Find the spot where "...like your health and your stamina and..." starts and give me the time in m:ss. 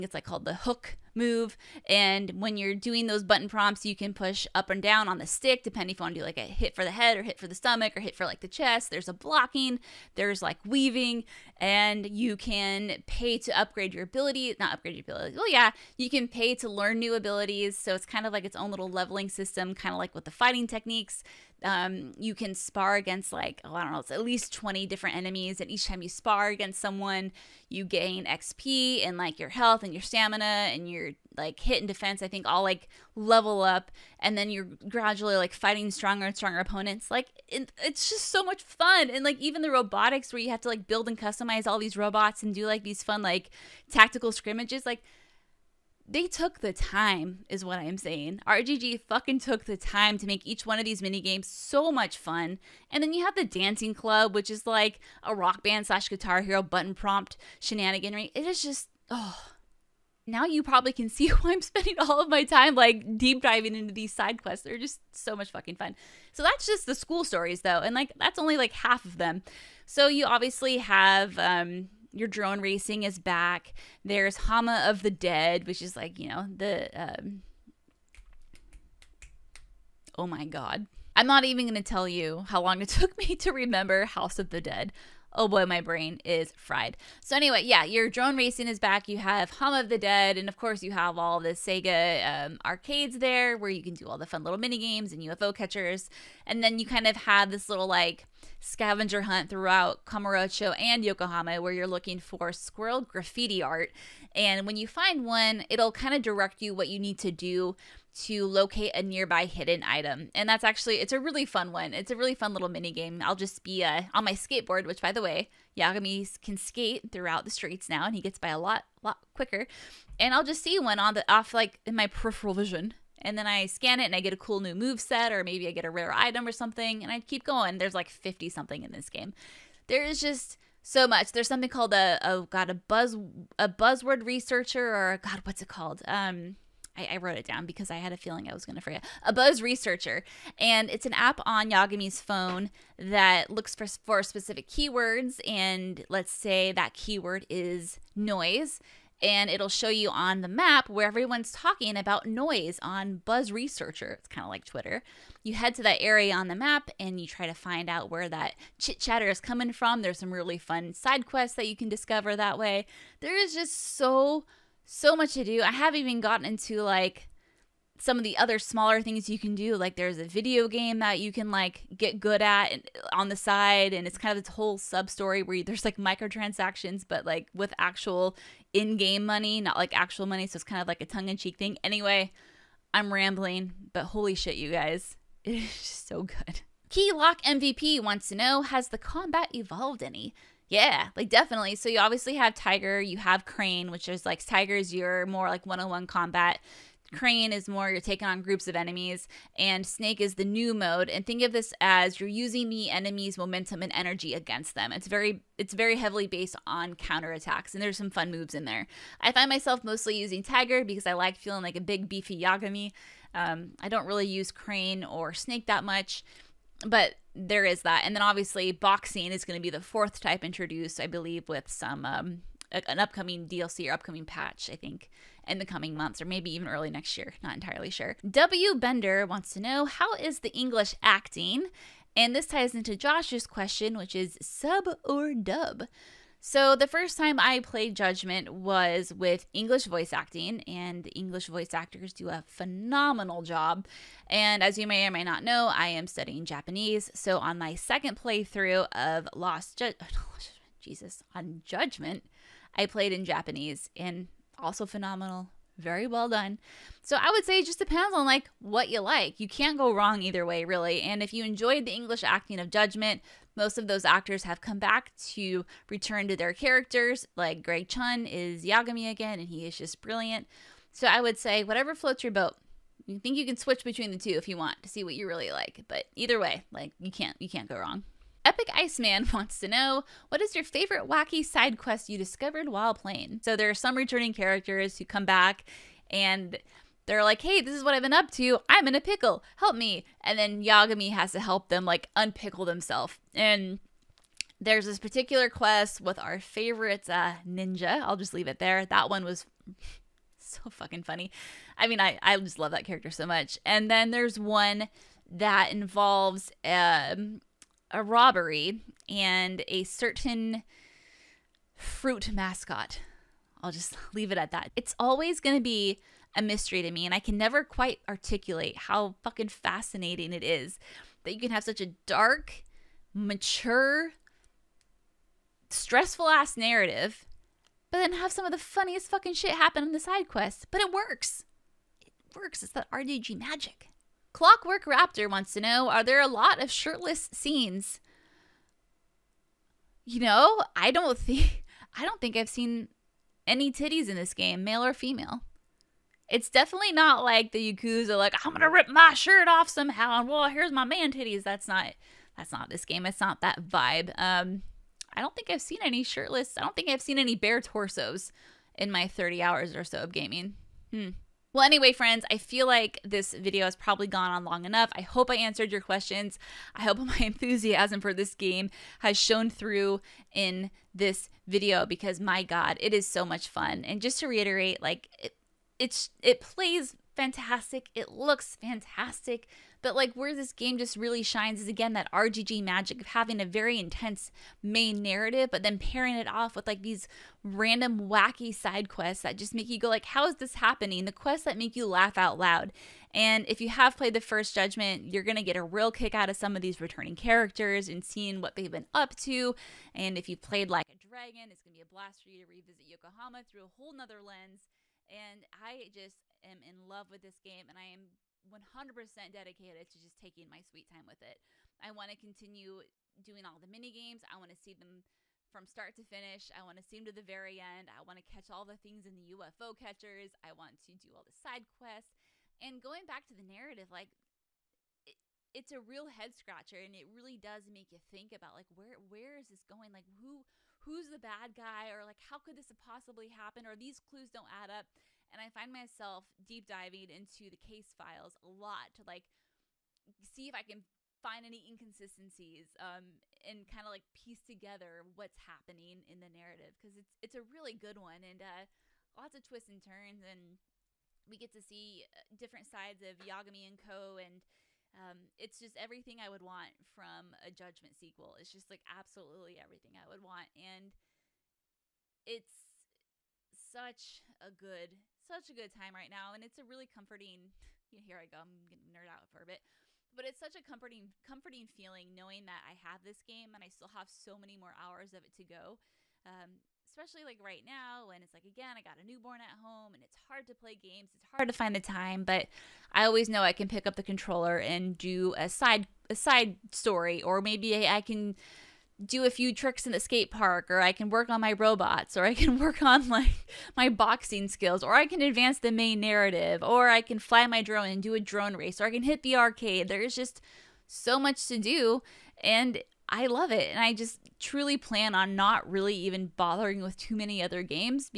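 0:29.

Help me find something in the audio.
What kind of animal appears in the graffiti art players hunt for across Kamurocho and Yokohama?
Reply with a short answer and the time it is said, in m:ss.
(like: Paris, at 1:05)
Squirrel, at 1:42.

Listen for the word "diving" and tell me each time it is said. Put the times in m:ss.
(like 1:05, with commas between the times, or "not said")
1:03, 7:16.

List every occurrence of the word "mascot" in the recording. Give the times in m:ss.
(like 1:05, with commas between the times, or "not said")
5:12.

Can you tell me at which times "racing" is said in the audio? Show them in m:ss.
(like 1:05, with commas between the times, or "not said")
1:12, 1:28.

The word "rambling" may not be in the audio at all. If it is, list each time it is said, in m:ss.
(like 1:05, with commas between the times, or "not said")
3:03.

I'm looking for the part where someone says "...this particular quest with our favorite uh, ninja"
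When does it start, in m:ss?
4:54.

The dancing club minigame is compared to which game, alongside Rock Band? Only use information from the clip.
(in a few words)
Guitar Hero.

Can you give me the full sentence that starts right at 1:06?
So that's just the school stories though, and like that's only like half of them.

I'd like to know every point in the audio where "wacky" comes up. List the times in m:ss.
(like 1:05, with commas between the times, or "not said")
4:41, 6:28.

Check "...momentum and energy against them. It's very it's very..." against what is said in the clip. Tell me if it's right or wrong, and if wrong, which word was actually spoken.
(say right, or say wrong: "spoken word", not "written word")
right.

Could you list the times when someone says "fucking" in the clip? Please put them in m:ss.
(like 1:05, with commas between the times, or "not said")
0:49, 1:05, 5:00, 5:19, 5:29.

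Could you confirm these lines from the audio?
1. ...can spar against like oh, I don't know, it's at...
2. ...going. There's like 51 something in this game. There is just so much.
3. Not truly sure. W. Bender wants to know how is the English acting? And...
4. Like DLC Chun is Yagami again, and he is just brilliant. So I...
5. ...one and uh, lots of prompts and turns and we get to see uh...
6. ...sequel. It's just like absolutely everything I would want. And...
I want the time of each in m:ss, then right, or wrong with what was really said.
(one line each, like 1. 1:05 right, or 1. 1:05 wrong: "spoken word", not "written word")
1. 0:22 right
2. 2:07 wrong: "50", not "51"
3. 3:47 wrong: "entirely", not "truly"
4. 4:27 wrong: "Greg", not "DLC"
5. 7:27 wrong: "twists", not "prompts"
6. 7:37 right.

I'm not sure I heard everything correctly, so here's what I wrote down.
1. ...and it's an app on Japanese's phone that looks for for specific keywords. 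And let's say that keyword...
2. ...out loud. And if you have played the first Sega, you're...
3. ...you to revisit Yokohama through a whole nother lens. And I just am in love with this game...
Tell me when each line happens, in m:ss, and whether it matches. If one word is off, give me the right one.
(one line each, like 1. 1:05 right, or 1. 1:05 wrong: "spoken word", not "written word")
1. 2:20 wrong: "Yagami", not "Japanese"
2. 6:32 wrong: "Judgment", not "Sega"
3. 6:42 right.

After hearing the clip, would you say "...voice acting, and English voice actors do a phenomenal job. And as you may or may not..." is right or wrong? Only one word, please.
right.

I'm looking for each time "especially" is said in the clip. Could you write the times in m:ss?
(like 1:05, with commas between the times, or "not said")
7:56.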